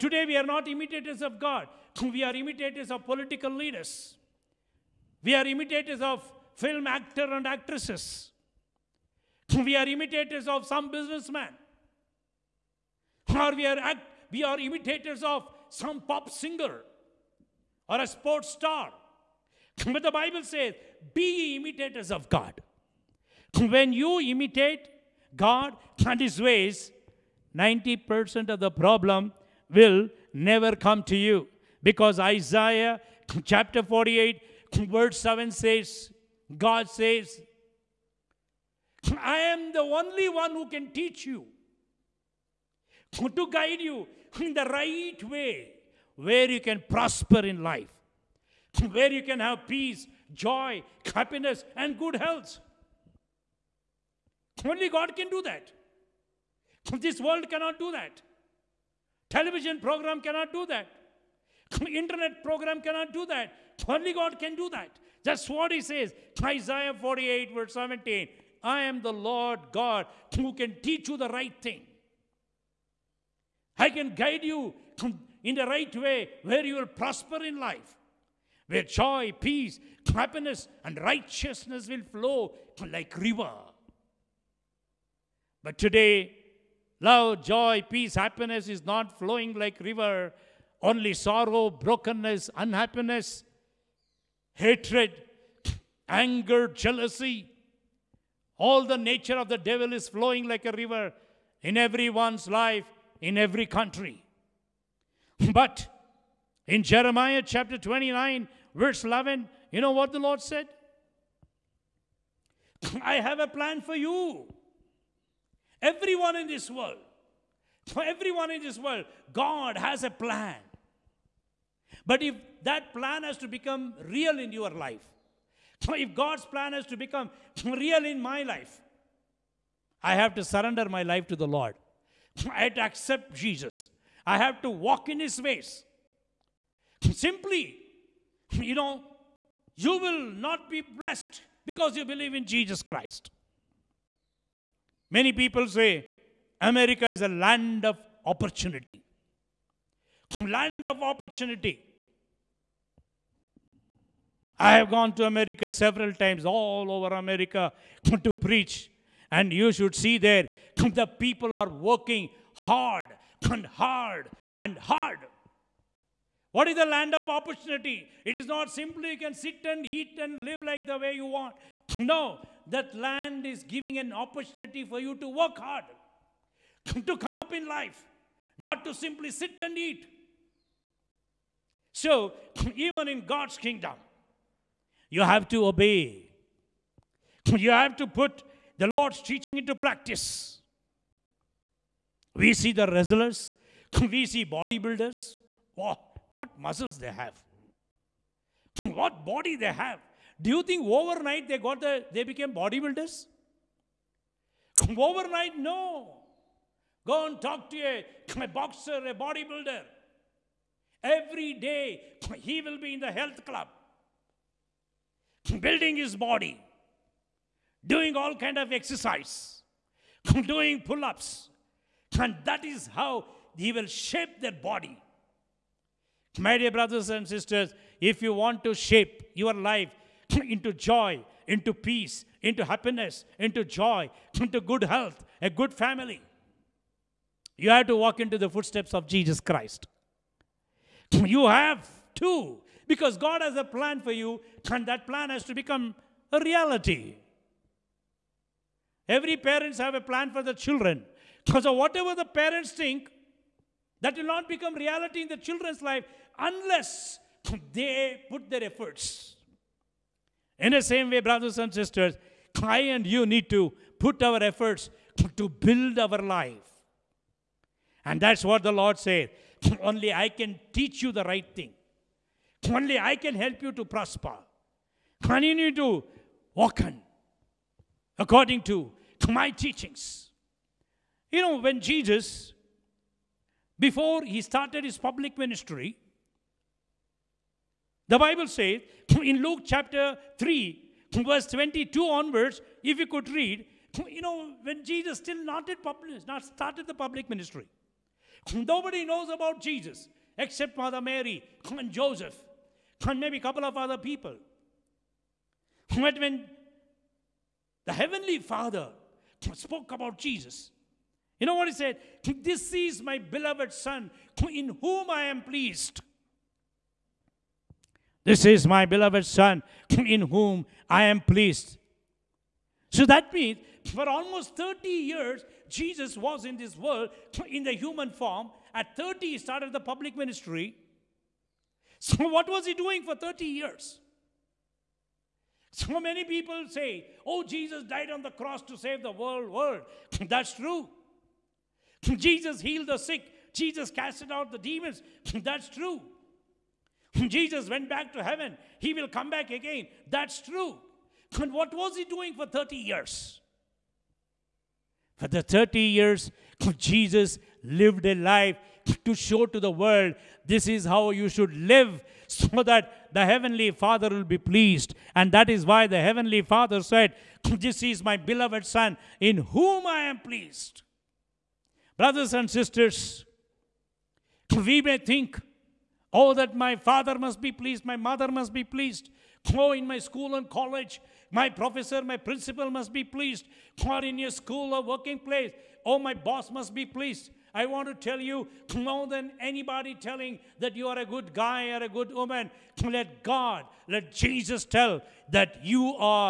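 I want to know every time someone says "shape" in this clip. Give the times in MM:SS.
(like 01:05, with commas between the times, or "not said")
03:43, 03:48.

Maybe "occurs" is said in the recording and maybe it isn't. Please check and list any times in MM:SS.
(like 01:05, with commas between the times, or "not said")
not said.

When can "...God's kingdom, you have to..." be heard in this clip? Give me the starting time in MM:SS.
03:03.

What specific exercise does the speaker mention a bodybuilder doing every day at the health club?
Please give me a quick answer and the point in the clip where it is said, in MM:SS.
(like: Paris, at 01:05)
Pull-ups, at 03:40.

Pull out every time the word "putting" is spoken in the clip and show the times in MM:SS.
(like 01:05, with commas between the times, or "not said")
not said.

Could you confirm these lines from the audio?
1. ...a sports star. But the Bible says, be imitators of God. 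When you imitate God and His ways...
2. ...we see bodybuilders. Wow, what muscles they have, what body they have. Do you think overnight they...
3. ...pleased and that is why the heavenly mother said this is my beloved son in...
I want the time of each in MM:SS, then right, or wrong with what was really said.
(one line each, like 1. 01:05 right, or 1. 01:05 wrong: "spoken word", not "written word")
1. 00:18 right
2. 03:14 right
3. 06:04 wrong: "father", not "mother".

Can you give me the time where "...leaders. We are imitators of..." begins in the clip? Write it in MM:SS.
00:03.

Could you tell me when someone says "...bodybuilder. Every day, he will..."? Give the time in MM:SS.
03:29.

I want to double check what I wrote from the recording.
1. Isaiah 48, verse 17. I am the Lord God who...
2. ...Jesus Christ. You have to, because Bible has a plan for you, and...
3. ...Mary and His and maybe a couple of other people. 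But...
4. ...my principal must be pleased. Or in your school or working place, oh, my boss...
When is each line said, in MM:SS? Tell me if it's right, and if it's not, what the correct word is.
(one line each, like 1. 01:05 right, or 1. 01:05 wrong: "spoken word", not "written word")
1. 01:06 right
2. 03:59 wrong: "God", not "Bible"
3. 05:01 wrong: "Joseph", not "His"
4. 06:22 right.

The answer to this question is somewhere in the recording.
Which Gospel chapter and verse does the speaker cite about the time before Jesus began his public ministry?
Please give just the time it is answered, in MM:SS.
04:49.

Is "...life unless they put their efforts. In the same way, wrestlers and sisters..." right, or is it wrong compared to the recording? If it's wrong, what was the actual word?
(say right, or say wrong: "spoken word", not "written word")
wrong: "brothers", not "wrestlers".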